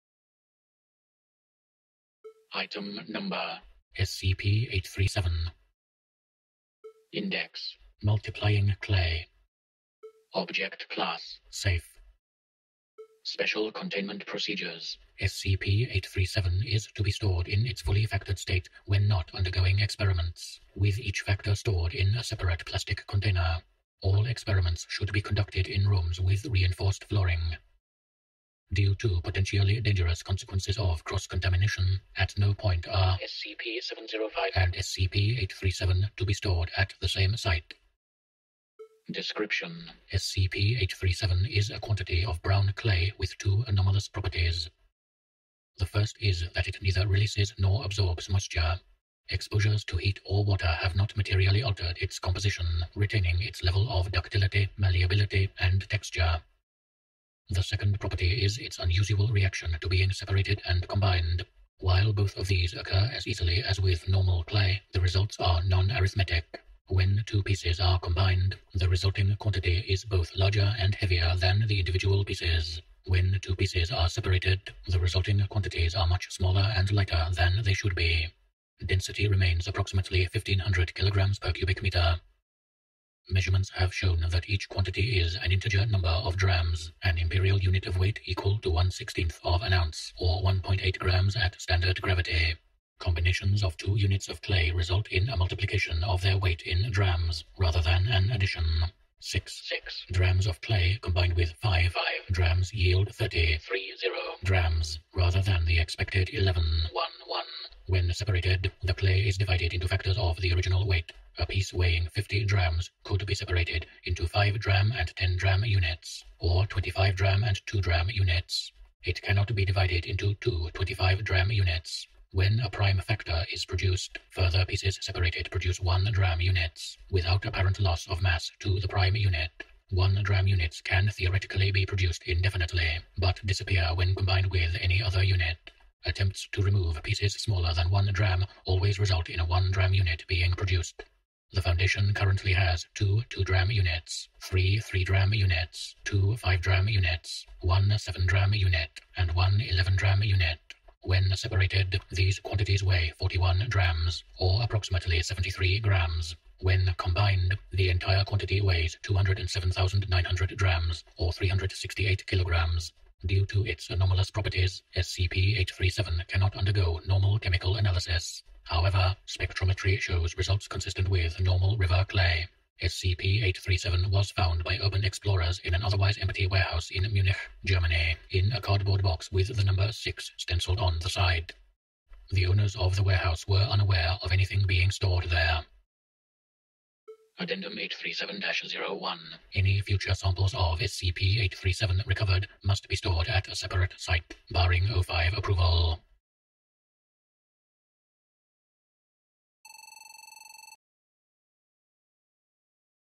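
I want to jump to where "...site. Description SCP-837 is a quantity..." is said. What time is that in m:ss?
0:37.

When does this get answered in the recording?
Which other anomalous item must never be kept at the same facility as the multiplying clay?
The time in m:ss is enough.
0:33.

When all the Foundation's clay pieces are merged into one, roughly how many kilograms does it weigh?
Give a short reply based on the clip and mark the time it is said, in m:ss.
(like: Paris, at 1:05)
368 kilograms, at 2:41.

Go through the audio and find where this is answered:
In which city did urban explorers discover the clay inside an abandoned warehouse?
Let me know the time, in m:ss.
2:57.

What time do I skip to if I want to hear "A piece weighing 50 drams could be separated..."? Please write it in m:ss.
1:51.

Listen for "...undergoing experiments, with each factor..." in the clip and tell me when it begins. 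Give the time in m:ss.
0:19.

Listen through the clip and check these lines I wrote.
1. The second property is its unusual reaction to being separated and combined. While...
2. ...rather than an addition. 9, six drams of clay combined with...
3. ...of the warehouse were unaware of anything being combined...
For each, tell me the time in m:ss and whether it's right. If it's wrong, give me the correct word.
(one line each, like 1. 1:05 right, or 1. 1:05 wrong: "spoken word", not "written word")
1. 0:57 right
2. 1:37 wrong: "6", not "9"
3. 3:02 wrong: "stored", not "combined".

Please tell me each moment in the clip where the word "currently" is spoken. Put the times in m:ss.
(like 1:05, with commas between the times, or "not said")
2:22.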